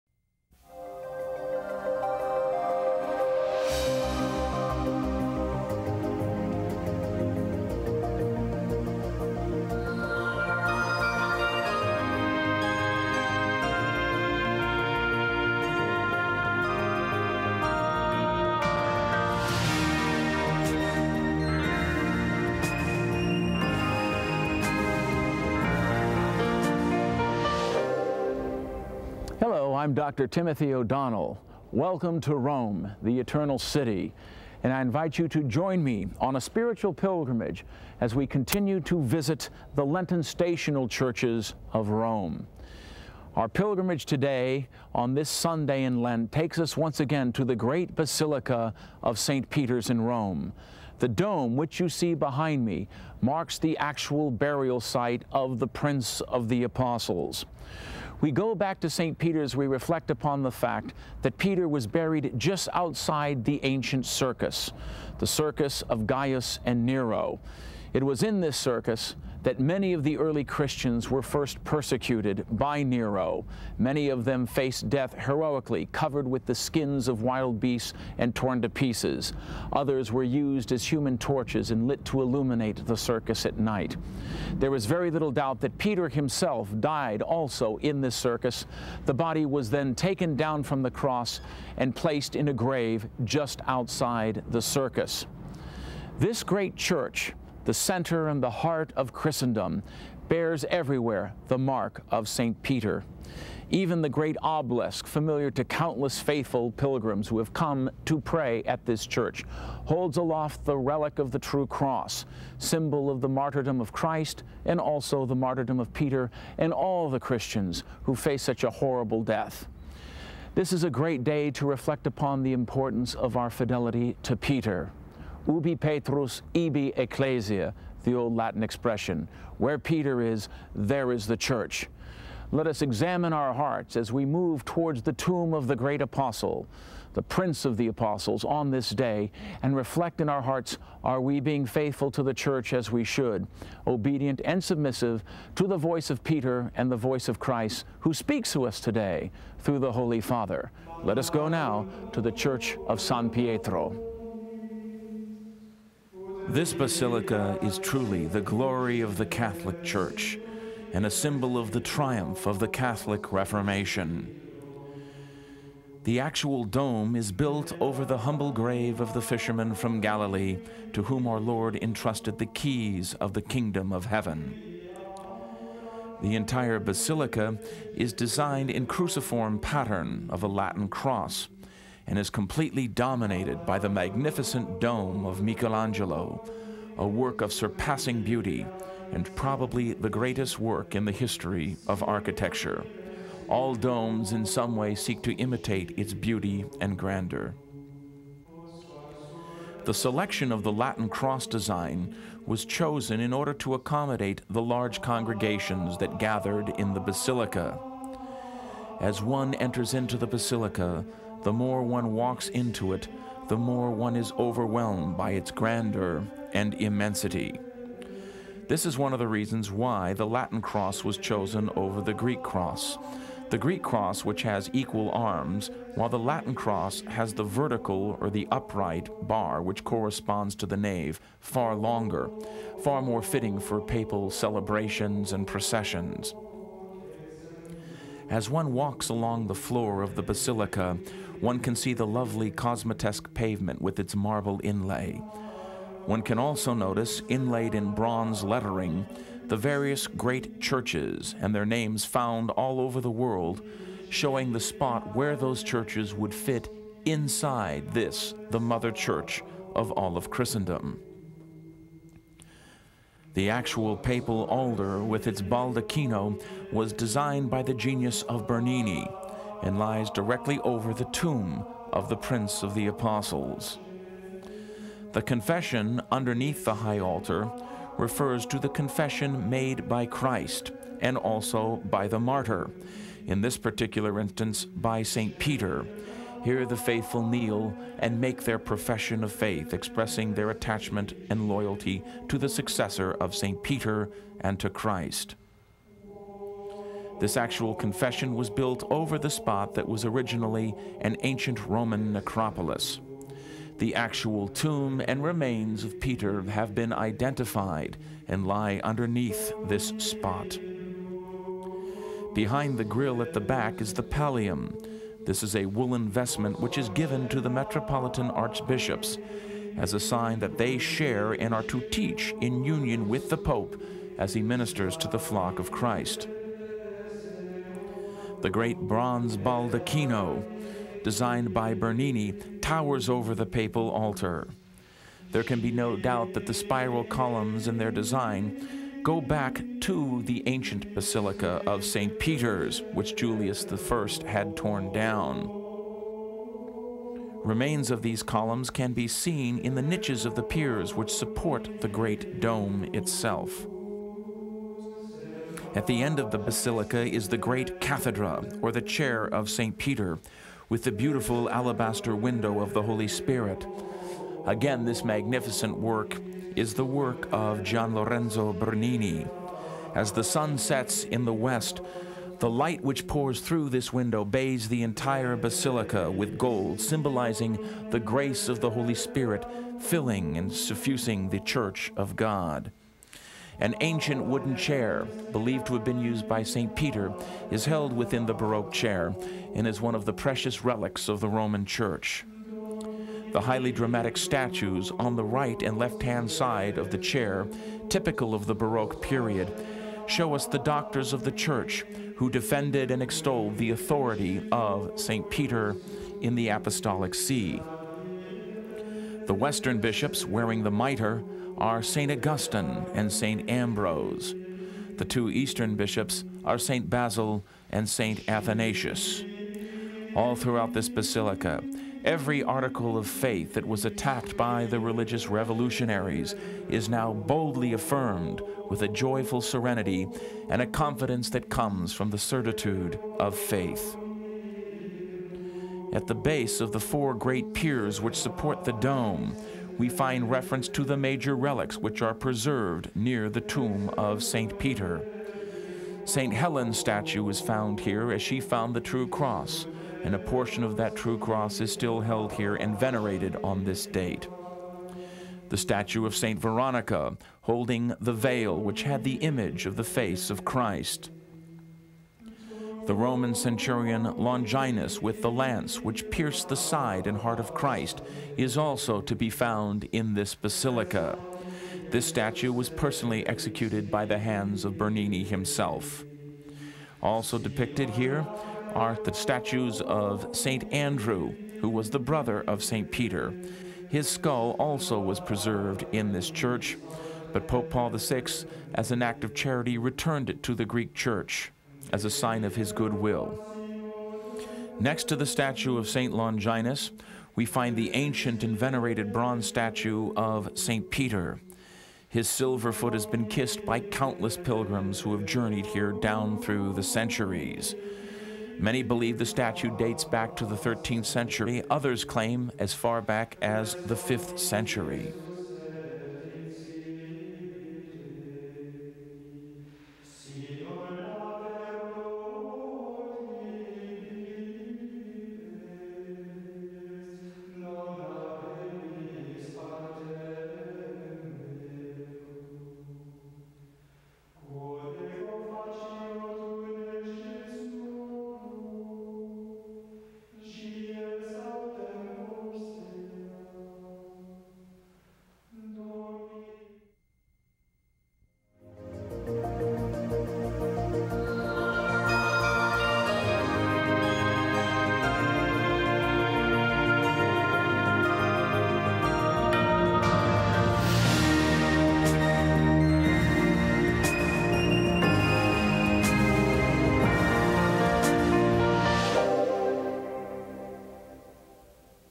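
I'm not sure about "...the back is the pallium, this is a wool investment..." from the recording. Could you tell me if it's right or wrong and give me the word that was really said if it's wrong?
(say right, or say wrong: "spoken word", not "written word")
right.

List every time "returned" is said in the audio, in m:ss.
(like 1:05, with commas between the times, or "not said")
8:09.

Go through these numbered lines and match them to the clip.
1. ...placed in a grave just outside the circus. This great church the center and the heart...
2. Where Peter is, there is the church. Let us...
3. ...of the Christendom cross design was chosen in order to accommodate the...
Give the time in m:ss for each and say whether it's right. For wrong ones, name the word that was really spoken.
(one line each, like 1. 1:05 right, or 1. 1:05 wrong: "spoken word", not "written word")
1. 1:31 right
2. 2:09 right
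3. 3:20 wrong: "Latin", not "Christendom".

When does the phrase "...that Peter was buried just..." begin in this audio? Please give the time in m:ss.
1:01.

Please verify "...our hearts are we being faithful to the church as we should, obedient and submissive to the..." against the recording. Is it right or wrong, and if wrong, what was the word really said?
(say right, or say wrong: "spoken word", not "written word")
right.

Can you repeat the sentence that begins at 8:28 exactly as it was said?
Many believe the statue dates back to the 13th century, others claim as far back as the 5th century.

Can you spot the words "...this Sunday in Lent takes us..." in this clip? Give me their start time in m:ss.
0:45.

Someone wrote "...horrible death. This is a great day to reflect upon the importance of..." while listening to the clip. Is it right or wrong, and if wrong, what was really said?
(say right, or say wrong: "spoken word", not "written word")
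right.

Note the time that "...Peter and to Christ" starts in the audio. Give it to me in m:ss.
4:53.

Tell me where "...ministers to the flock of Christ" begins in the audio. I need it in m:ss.
5:24.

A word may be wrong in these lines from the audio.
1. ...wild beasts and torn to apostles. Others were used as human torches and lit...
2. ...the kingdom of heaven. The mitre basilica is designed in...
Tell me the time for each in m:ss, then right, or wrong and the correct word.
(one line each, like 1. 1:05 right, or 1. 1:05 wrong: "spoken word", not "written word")
1. 1:17 wrong: "pieces", not "apostles"
2. 2:53 wrong: "entire", not "mitre".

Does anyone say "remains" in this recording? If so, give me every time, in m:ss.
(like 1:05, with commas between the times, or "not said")
5:05, 5:47.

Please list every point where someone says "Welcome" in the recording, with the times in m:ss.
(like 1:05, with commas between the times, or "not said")
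0:31.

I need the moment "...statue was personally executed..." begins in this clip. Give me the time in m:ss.
7:52.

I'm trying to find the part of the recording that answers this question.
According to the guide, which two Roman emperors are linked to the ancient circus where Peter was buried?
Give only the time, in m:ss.
1:06.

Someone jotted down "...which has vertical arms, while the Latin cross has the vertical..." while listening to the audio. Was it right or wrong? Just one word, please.
wrong.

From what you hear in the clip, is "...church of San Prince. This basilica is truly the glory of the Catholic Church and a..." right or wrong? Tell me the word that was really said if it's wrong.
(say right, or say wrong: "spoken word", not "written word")
wrong: "Pietro", not "Prince".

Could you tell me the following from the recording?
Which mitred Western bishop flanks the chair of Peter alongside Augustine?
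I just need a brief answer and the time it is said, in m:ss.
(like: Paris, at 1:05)
St. Ambrose, at 6:53.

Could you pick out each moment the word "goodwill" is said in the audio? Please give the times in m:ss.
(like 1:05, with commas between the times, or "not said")
8:12.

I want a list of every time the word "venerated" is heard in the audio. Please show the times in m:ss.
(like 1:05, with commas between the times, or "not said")
7:32, 8:18.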